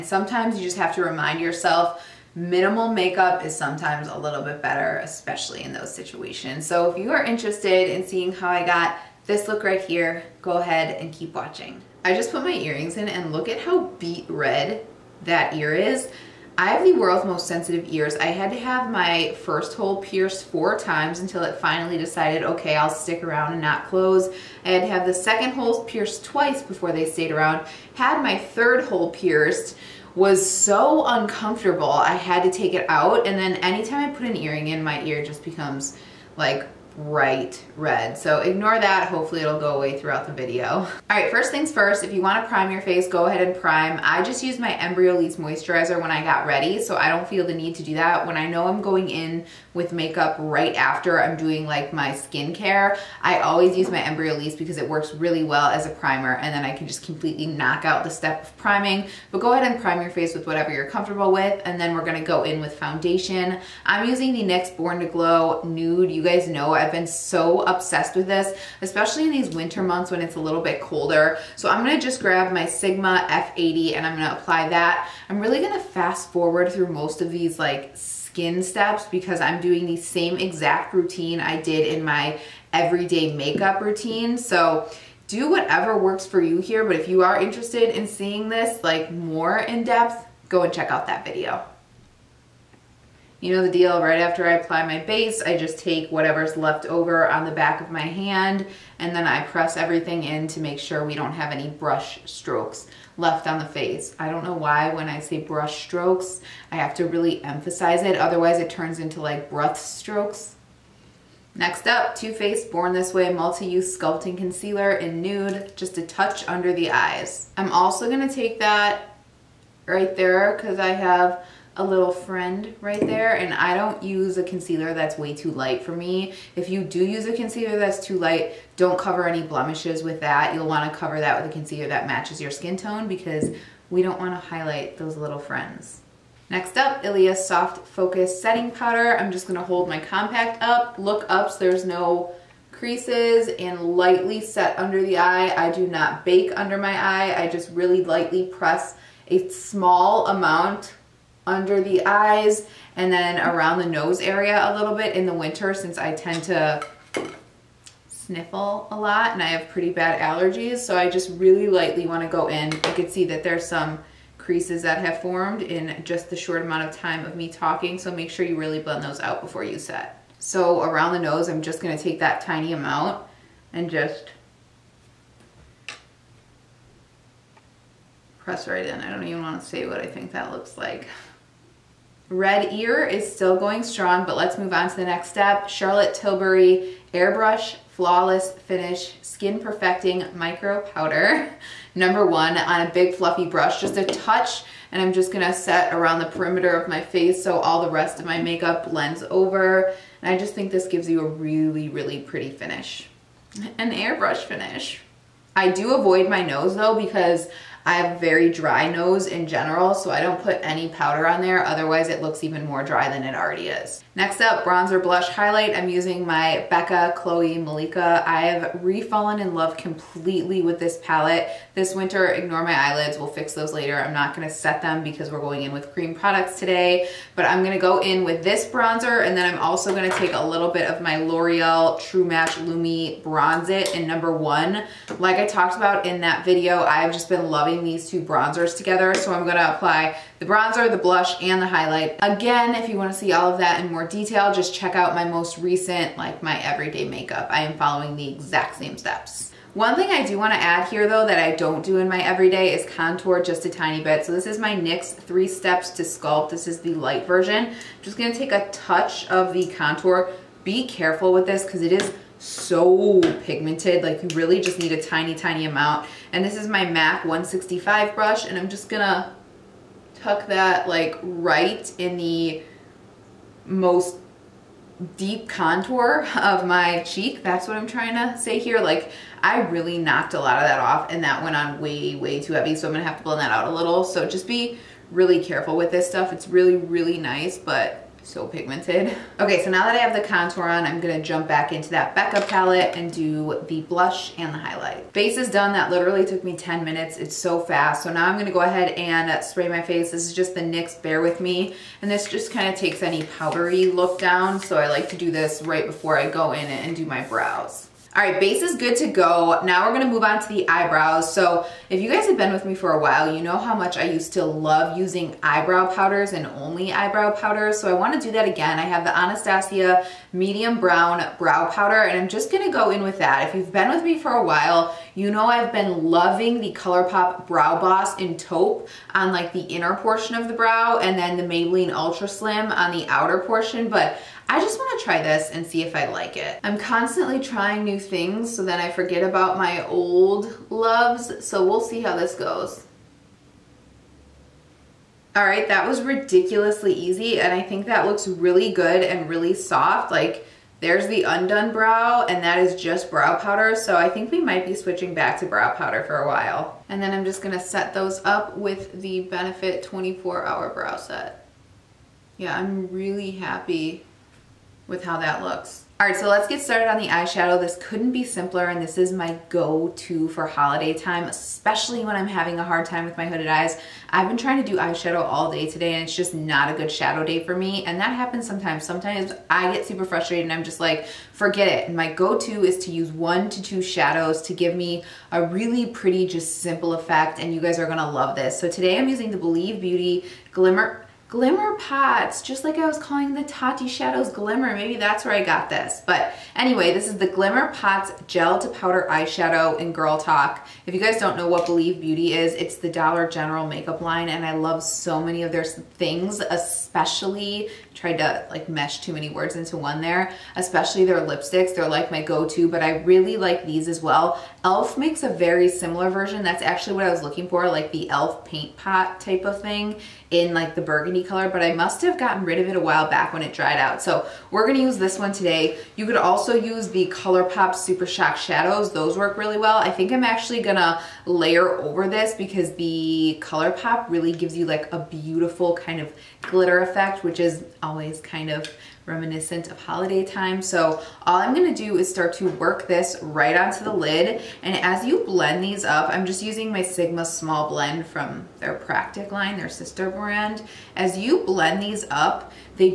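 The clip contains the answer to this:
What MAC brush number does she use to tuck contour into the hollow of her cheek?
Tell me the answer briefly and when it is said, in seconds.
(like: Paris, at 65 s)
165, at 267 s.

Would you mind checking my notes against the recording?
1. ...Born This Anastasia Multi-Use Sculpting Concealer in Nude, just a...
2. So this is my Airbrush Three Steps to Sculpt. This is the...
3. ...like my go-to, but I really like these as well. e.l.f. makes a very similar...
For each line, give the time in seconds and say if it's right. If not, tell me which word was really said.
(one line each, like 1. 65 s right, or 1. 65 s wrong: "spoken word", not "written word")
1. 112 s wrong: "Way", not "Anastasia"
2. 254 s wrong: "NYX", not "Airbrush"
3. 411 s right.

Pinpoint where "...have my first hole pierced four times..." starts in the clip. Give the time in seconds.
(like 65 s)
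18 s.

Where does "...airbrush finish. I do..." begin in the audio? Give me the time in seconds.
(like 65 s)
203 s.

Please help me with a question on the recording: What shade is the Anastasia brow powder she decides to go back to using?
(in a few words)
Medium Brown.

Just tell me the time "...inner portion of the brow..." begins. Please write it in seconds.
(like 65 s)
329 s.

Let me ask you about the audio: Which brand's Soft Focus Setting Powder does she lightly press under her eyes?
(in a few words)
Ilia.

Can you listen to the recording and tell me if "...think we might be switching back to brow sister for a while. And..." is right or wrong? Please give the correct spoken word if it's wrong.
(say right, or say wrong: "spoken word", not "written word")
wrong: "powder", not "sister".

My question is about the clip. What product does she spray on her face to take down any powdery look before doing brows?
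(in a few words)
NYX Bare With Me.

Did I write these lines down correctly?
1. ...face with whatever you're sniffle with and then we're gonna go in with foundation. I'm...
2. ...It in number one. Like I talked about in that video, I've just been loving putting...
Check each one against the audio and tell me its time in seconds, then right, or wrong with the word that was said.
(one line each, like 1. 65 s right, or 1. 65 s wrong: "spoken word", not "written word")
1. 60 s wrong: "comfortable", not "sniffle"
2. 233 s right.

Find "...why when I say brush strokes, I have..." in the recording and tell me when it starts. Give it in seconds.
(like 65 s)
104 s.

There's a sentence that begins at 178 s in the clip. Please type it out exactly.
I don't even want to say what I think that looks like.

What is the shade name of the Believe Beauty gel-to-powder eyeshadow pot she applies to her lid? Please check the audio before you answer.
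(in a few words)
Girl Talk.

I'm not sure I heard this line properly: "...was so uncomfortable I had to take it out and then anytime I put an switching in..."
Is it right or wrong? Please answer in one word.
wrong.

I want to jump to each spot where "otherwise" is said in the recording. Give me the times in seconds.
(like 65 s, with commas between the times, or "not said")
108 s, 211 s.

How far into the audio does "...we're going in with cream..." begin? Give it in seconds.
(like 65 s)
225 s.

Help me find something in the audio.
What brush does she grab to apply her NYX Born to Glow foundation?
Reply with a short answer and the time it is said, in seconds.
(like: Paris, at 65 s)
Sigma F80, at 72 s.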